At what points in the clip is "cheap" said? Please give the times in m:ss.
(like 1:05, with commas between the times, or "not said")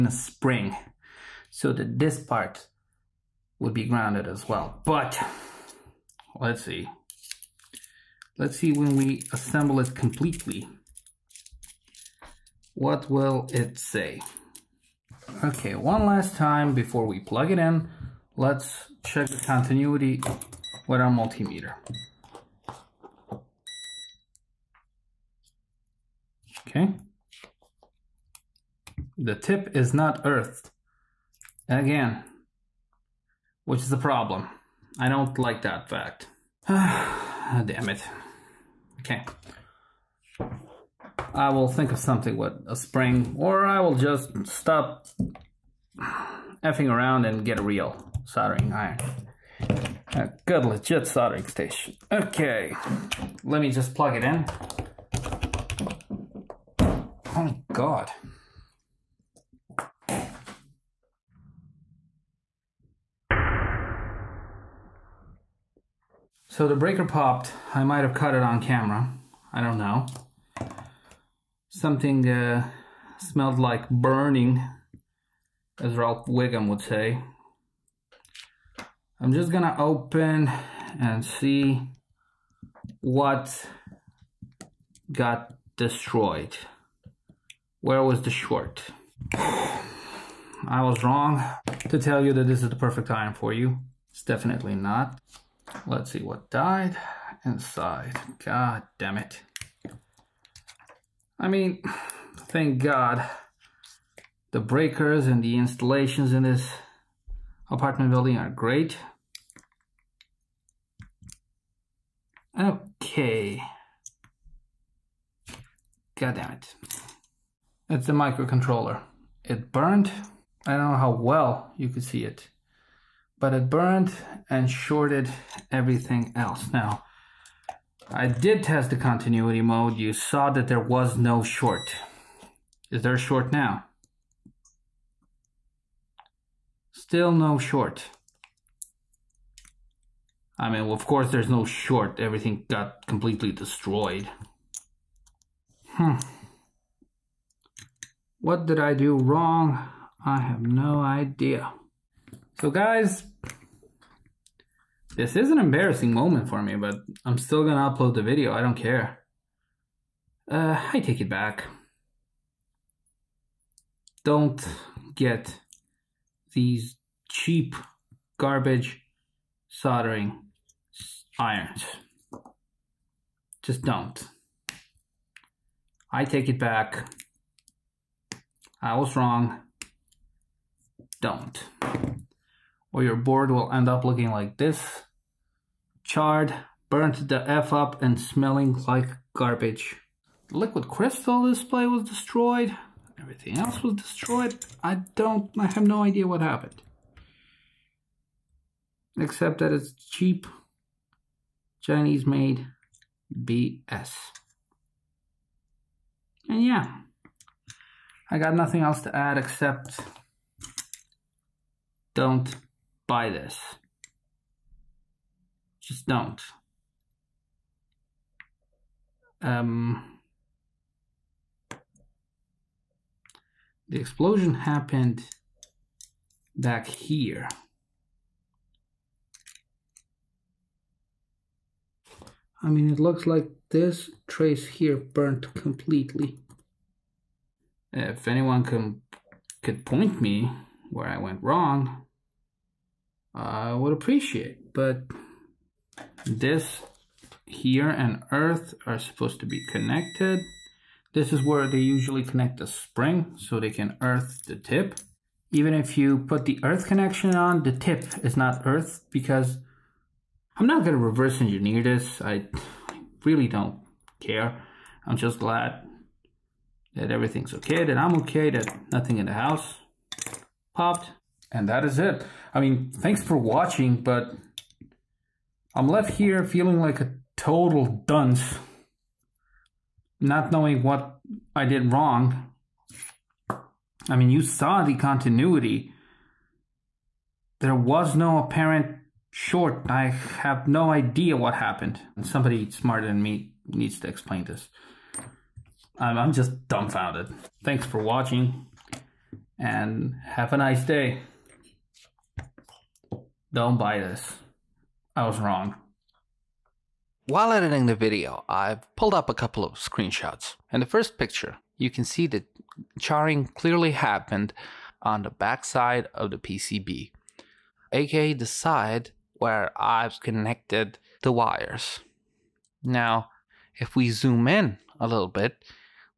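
2:47, 3:19.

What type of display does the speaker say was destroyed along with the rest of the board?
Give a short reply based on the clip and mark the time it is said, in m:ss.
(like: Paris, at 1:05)
Liquid crystal display, at 3:10.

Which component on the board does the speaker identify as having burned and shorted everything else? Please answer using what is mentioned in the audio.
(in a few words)
The microcontroller.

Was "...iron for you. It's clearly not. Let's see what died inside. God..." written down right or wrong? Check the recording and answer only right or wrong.
wrong.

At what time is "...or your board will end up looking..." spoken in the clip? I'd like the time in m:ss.
3:02.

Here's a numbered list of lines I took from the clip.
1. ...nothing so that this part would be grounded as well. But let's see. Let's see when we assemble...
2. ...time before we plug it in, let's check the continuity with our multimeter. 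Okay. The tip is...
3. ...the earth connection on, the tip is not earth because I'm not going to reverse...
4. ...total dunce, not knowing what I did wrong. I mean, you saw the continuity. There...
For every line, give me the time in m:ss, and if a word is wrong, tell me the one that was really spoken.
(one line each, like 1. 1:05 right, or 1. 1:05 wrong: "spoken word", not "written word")
1. 0:00 wrong: "spring", not "nothing"
2. 0:16 right
3. 4:16 right
4. 4:37 right.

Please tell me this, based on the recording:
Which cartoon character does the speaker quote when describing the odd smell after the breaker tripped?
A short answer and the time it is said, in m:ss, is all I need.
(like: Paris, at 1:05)
Ralph Wiggum, at 1:15.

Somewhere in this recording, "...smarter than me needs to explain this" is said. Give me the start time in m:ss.
4:52.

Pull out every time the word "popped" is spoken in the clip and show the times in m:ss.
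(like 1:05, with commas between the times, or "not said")
1:07, 4:30.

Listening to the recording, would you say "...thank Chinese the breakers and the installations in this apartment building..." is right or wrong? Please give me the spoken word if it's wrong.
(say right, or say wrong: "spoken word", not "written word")
wrong: "God", not "Chinese".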